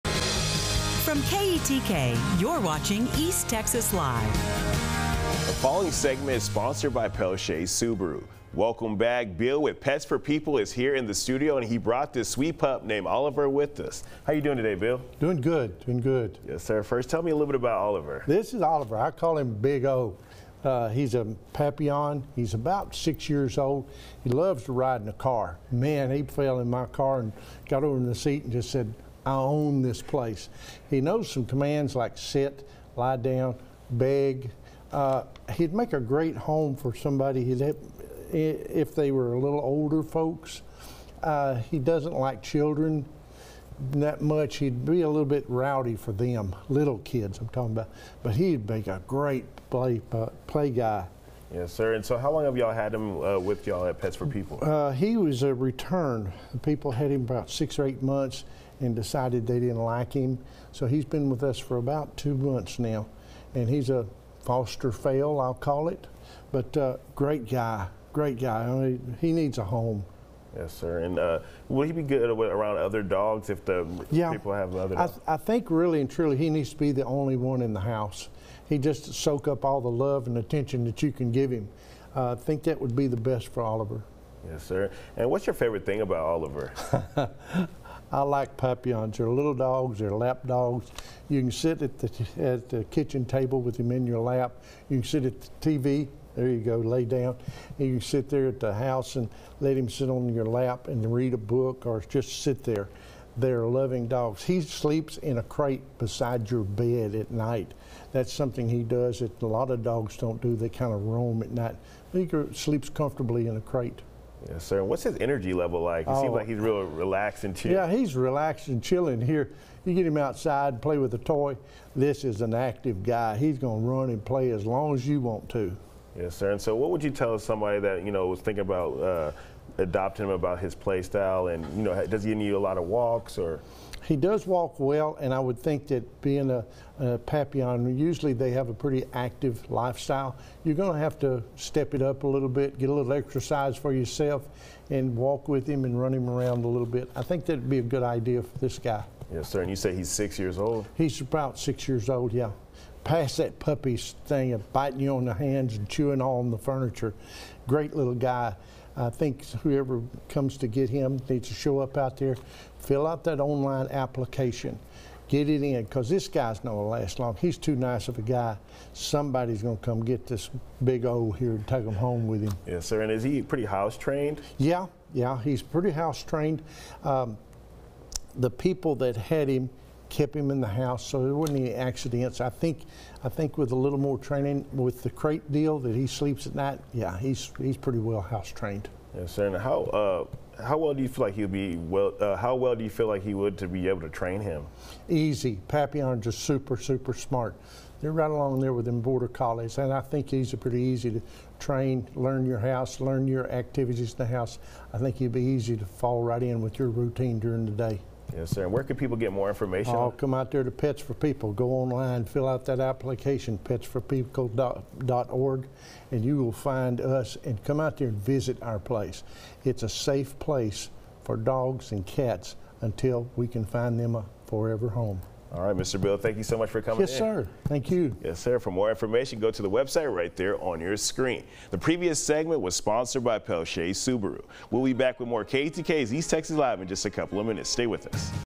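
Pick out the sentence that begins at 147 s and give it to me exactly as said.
I think that'd be a good idea for this guy.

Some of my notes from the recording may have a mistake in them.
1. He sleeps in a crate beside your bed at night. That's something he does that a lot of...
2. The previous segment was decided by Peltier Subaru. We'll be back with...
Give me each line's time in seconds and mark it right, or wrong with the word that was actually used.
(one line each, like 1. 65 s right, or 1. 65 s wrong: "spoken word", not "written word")
1. 104 s right
2. 231 s wrong: "sponsored", not "decided".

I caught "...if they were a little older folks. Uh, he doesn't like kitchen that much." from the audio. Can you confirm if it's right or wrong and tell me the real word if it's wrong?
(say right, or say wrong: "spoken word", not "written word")
wrong: "children", not "kitchen".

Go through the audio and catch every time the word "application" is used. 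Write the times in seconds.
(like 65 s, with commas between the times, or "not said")
163 s, 212 s.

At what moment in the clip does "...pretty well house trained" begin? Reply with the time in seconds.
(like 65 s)
187 s.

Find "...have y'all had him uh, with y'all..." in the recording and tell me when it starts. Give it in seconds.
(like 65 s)
52 s.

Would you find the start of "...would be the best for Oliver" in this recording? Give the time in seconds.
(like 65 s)
82 s.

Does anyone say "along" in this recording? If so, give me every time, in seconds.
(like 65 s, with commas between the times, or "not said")
198 s.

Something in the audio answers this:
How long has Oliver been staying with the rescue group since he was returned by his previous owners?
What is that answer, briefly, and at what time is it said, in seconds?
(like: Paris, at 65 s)
About two months, at 61 s.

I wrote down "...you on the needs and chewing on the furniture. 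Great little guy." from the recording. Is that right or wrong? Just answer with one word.
wrong.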